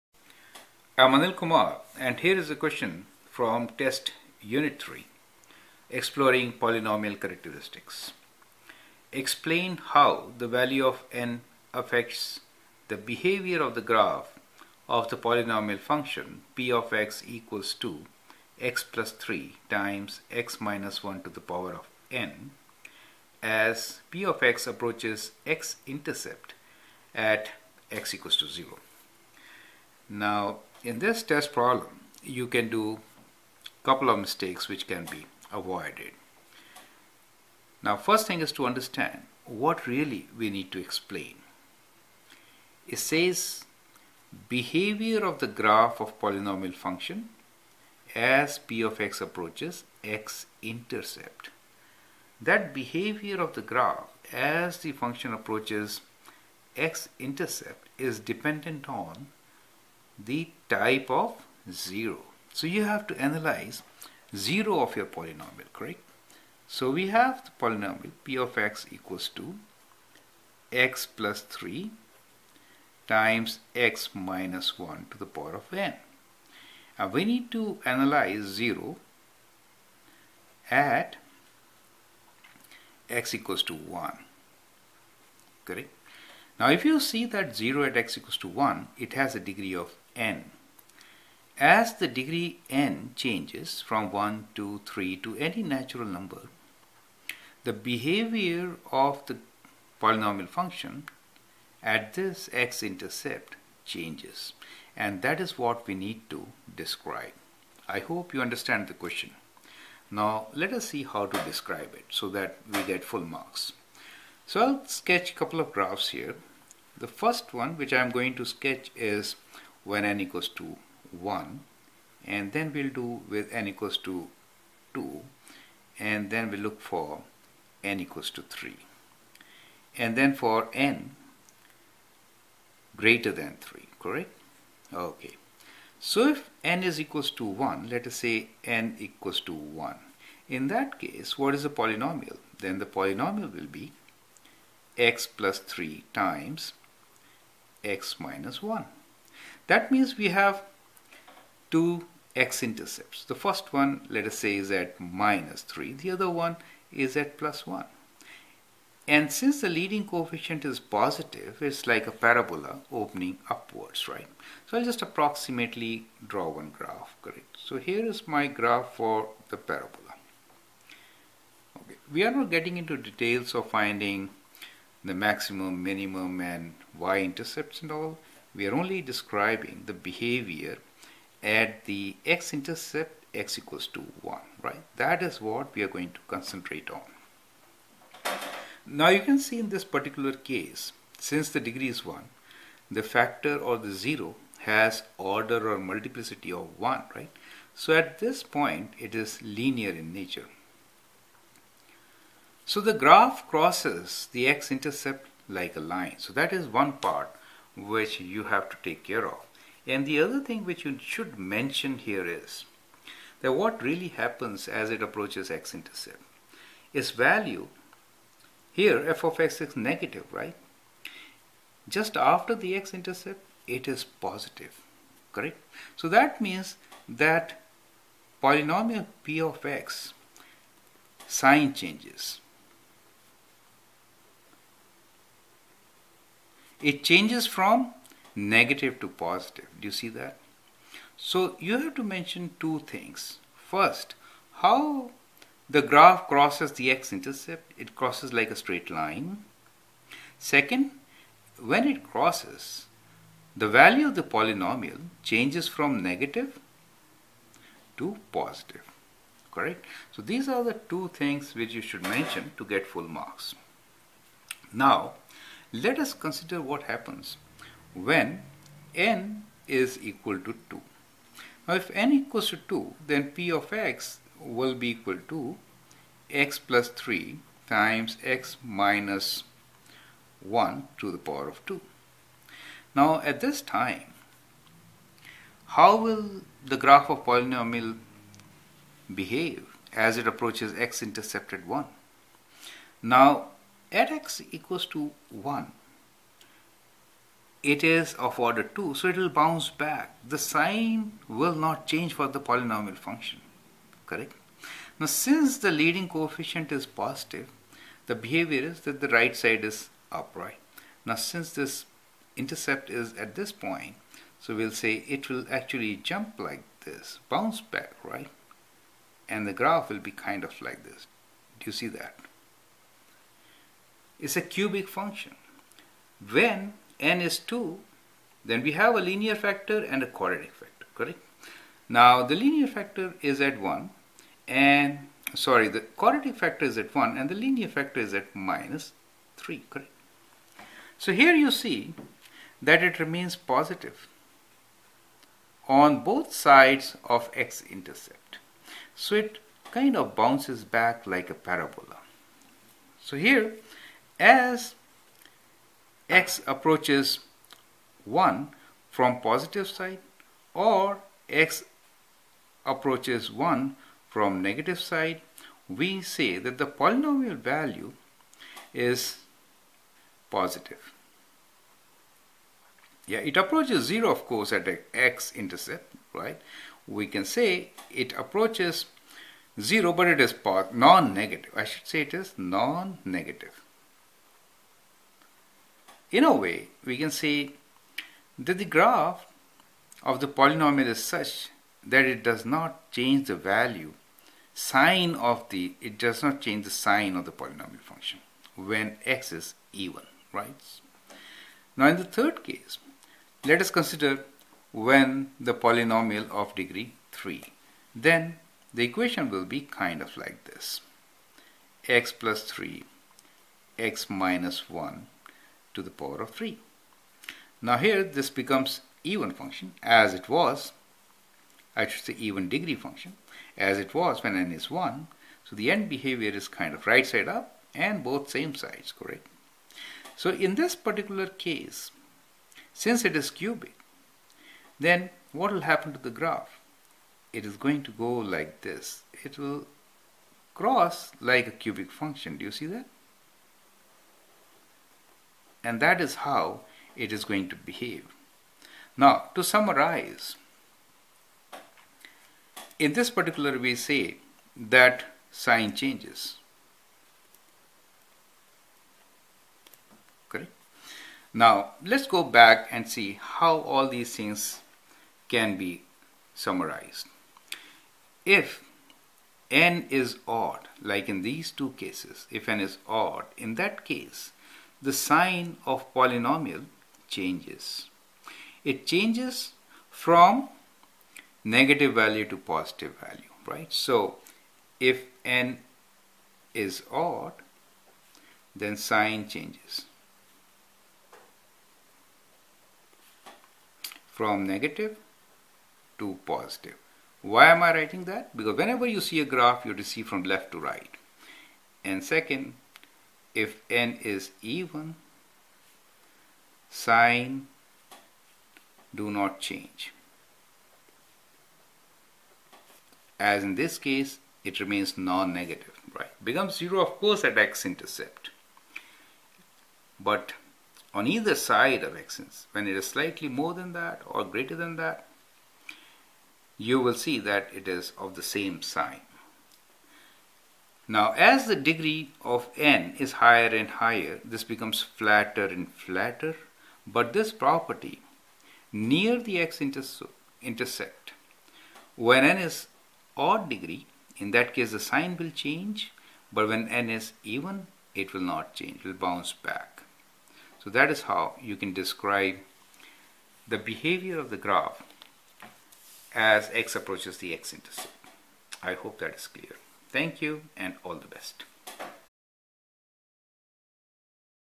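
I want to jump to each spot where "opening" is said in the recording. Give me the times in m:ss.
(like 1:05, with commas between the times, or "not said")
2:42.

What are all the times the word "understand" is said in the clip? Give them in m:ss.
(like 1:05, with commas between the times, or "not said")
0:38, 1:48.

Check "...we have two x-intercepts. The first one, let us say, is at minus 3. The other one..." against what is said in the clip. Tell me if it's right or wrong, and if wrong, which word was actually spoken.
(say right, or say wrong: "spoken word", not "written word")
right.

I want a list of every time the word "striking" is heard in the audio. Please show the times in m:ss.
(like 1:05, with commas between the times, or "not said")
not said.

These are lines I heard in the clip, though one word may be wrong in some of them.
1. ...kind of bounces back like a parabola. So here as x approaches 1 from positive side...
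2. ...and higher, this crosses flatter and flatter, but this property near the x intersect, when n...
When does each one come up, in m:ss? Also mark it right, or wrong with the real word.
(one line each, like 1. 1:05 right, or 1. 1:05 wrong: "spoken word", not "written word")
1. 5:49 right
2. 8:53 wrong: "becomes", not "crosses".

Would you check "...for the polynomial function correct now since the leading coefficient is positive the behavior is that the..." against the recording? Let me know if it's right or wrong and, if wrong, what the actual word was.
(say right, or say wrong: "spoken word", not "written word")
right.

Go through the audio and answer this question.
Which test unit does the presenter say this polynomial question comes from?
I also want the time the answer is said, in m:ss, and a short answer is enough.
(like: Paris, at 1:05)
3, at 0:03.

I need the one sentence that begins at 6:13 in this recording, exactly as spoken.
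Yeah, it approaches 0 of course at x-intercept, right?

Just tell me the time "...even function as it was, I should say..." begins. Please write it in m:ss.
6:59.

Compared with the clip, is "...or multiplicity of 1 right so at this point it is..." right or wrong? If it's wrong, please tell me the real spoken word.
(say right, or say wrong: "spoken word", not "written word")
right.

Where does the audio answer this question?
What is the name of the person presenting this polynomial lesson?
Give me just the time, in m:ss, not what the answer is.
0:01.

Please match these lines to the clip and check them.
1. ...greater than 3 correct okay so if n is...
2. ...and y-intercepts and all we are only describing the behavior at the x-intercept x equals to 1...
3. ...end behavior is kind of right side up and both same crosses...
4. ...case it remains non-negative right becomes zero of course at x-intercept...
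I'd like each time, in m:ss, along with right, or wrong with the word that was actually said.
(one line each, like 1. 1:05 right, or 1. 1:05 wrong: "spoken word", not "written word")
1. 2:12 right
2. 2:56 right
3. 7:05 wrong: "sides", not "crosses"
4. 8:33 right.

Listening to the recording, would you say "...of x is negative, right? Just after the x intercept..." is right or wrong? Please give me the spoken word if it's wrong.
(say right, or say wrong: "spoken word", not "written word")
right.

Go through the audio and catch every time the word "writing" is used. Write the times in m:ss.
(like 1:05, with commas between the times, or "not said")
8:17.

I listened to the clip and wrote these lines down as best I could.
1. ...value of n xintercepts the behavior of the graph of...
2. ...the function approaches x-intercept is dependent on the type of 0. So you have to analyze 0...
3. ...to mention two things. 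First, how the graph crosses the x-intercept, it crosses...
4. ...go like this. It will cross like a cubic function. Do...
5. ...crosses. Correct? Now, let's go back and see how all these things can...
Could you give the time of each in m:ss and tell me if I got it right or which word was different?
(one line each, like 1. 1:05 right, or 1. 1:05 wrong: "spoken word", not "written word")
1. 0:10 wrong: "affects", not "xintercepts"
2. 0:54 right
3. 4:01 right
4. 7:17 right
5. 7:35 wrong: "changes", not "crosses".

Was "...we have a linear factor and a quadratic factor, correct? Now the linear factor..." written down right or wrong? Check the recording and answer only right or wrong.
right.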